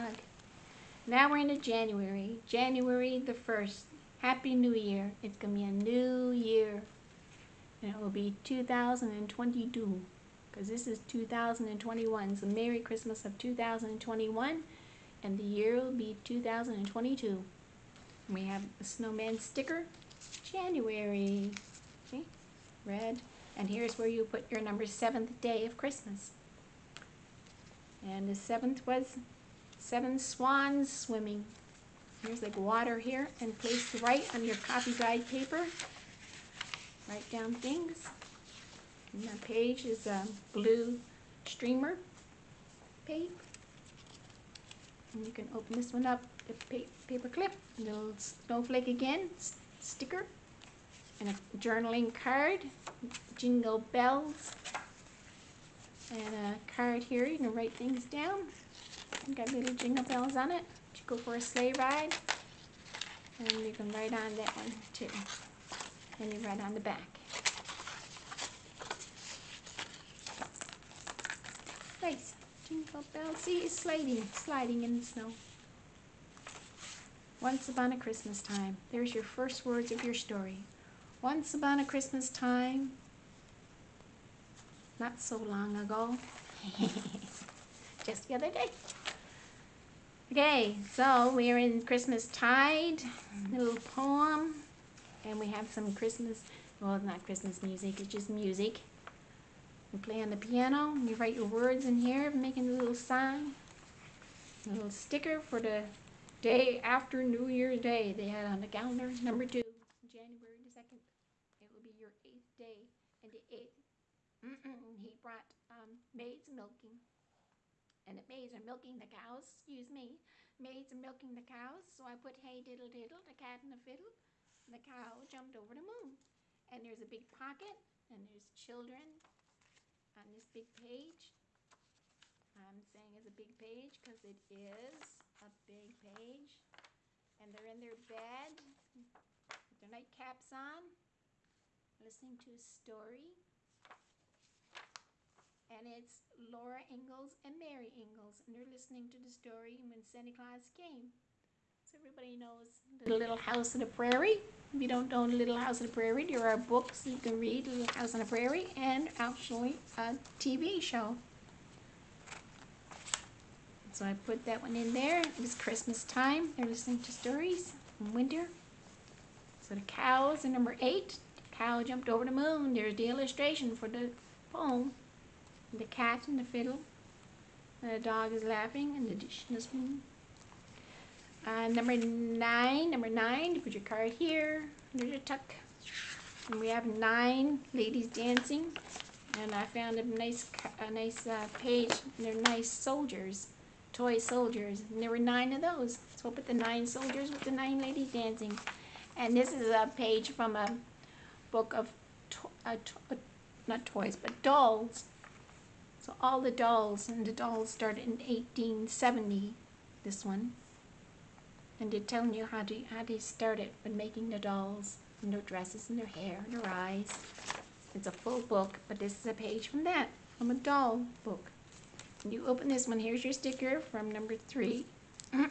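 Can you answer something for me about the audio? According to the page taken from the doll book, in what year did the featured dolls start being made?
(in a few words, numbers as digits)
1870.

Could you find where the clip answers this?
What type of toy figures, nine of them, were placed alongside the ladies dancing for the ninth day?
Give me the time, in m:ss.
3:13.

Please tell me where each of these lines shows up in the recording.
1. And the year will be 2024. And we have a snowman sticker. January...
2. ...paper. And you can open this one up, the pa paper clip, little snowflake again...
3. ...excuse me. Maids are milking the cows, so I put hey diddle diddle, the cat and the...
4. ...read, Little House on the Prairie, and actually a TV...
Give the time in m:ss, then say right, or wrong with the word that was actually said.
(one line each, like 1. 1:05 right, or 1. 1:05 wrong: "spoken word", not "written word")
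1. 0:15 wrong: "2022", not "2024"
2. 0:43 right
3. 1:59 right
4. 2:37 right.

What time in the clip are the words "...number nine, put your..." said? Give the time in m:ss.
3:02.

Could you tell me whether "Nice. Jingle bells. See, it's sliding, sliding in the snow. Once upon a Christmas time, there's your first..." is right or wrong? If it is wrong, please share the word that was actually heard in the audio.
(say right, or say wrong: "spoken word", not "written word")
right.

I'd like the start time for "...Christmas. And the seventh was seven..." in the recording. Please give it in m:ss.
0:25.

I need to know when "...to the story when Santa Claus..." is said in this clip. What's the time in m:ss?
2:29.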